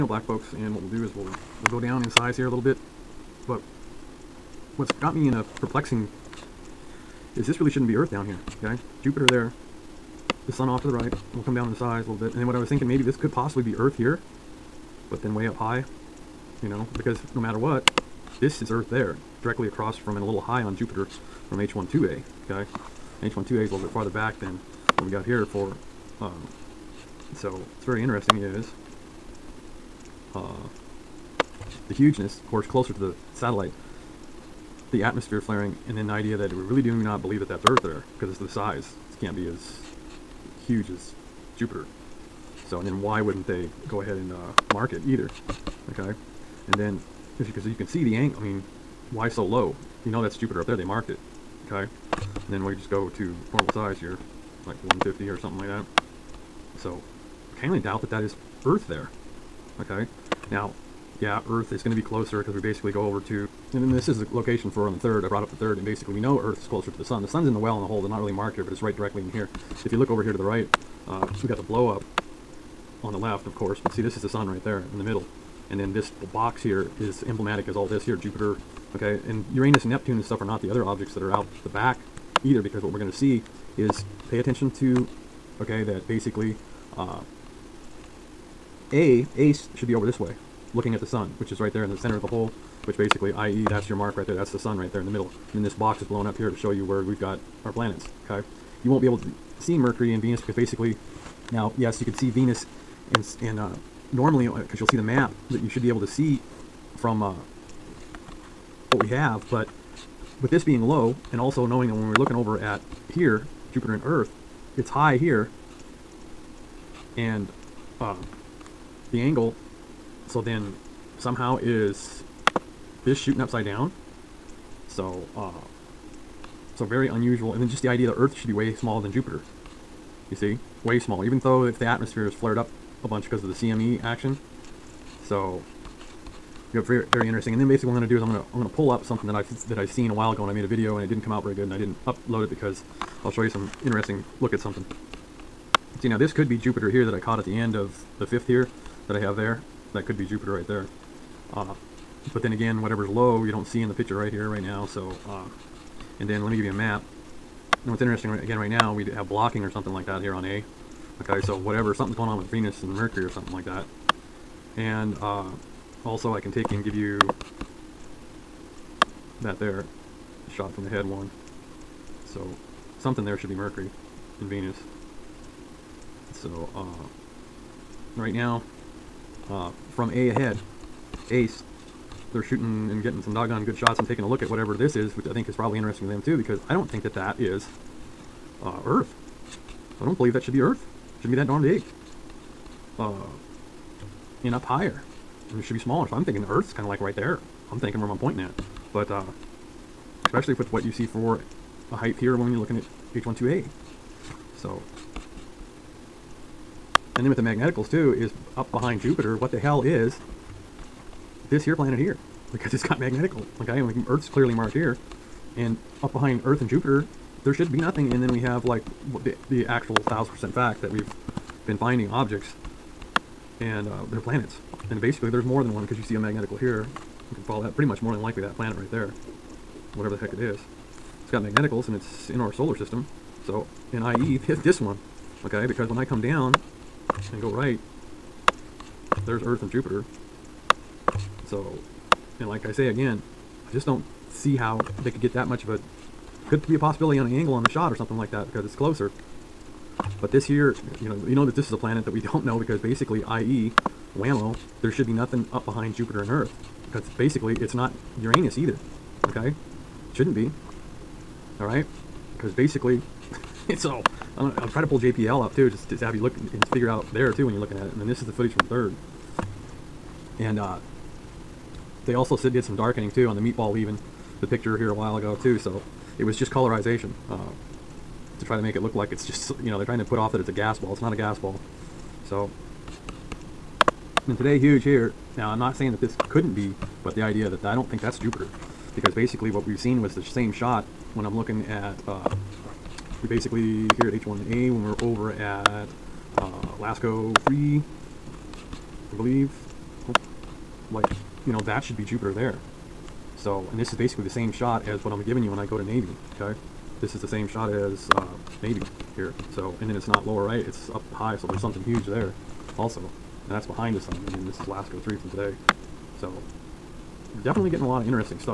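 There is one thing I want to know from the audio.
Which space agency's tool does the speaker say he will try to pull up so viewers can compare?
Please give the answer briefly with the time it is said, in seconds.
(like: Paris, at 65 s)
JPL, at 264 s.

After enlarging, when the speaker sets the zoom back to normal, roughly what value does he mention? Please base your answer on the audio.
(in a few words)
150.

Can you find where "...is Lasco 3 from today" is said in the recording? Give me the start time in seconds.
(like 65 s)
314 s.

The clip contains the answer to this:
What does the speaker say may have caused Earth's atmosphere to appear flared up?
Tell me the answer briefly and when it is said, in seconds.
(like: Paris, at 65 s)
CME action, at 133 s.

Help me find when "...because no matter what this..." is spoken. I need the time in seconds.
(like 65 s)
16 s.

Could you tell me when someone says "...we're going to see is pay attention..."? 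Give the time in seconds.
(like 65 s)
82 s.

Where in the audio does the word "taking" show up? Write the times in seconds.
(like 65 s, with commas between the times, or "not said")
184 s.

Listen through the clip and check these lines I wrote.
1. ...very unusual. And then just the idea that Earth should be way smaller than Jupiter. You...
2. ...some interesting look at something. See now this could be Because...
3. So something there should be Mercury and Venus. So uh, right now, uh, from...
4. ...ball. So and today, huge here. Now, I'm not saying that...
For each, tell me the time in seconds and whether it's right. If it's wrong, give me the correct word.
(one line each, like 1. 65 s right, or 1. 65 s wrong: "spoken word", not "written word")
1. 126 s right
2. 143 s wrong: "Jupiter", not "Because"
3. 172 s right
4. 281 s right.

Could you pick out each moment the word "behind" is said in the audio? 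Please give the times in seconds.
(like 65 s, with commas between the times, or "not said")
208 s, 216 s, 255 s, 313 s.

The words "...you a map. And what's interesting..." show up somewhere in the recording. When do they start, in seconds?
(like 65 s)
156 s.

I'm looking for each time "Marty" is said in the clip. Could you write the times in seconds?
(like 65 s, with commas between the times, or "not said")
not said.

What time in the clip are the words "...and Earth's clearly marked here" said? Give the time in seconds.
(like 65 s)
213 s.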